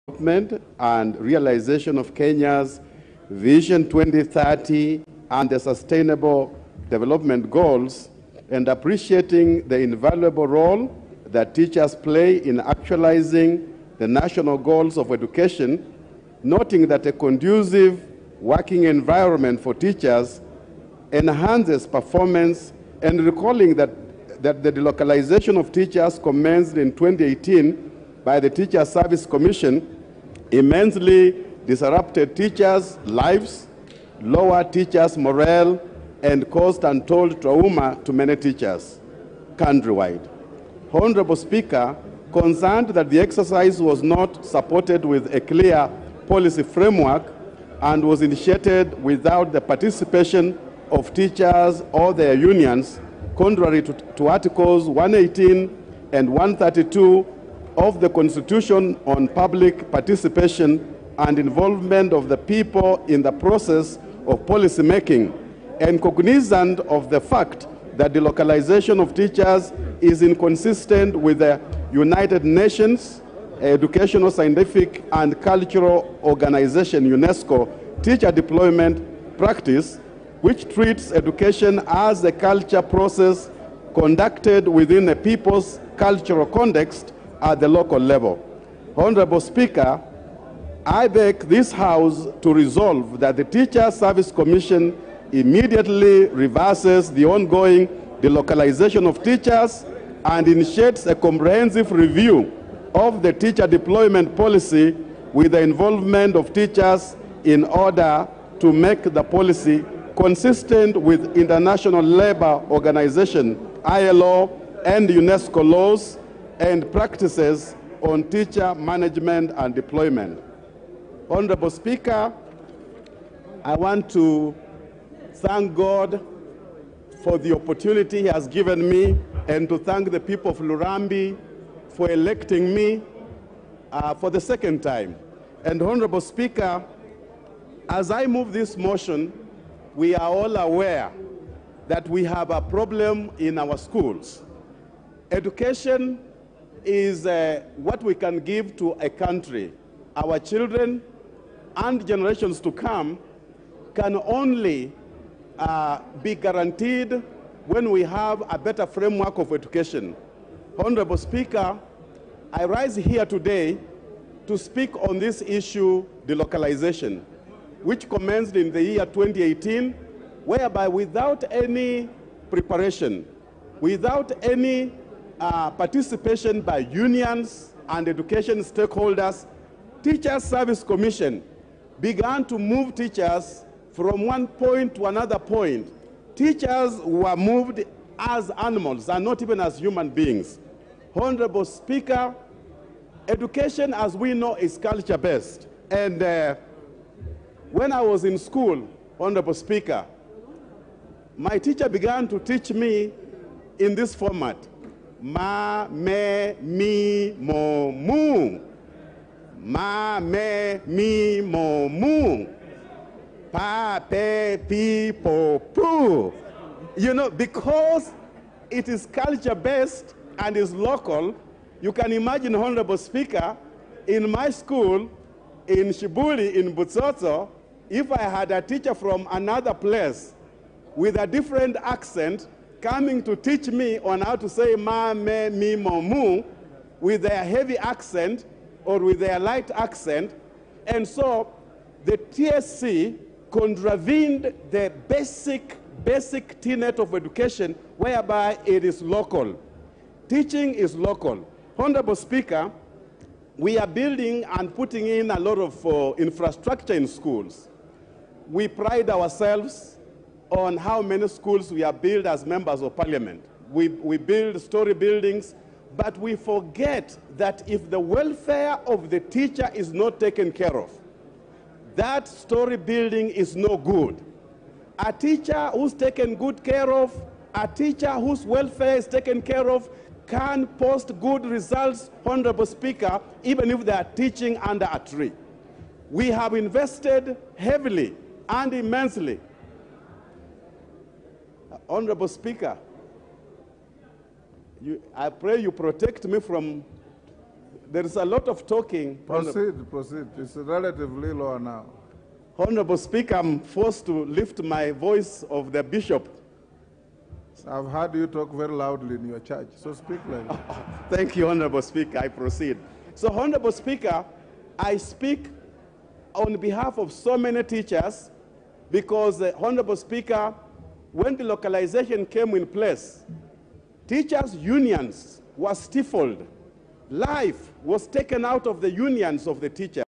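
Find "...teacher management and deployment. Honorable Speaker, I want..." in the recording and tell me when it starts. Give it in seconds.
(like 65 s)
118 s.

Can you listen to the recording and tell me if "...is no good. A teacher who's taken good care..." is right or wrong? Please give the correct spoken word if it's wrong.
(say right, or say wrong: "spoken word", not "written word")
right.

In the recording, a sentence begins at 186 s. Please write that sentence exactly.
Teachers were moved as animals and not even as human beings.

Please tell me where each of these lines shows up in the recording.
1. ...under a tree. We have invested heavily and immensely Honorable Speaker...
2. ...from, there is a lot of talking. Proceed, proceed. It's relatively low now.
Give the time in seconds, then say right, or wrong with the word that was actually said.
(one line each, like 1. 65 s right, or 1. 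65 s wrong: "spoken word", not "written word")
1. 284 s right
2. 296 s right.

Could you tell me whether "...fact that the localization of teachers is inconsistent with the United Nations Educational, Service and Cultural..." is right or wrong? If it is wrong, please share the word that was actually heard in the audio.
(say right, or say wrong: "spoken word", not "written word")
wrong: "Scientific", not "Service".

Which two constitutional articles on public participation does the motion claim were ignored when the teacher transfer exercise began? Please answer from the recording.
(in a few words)
Articles 118 and 132.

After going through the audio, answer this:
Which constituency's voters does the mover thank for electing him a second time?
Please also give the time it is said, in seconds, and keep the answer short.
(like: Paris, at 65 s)
Lurambi, at 130 s.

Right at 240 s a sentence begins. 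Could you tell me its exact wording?
And so the TSC contravened the basic, basic tenet of education whereby it is local.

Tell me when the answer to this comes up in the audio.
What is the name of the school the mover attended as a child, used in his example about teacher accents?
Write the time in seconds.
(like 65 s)
225 s.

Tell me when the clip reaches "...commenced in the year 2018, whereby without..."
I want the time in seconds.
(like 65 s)
168 s.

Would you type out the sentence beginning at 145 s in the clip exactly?
Education is uh, what we can give to a country.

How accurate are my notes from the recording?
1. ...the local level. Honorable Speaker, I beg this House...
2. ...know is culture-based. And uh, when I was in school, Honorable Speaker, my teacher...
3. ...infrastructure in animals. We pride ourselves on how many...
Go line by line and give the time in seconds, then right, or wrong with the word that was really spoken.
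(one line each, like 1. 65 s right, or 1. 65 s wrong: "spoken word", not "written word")
1. 87 s right
2. 194 s right
3. 256 s wrong: "schools", not "animals".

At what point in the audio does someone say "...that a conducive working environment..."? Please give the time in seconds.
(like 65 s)
16 s.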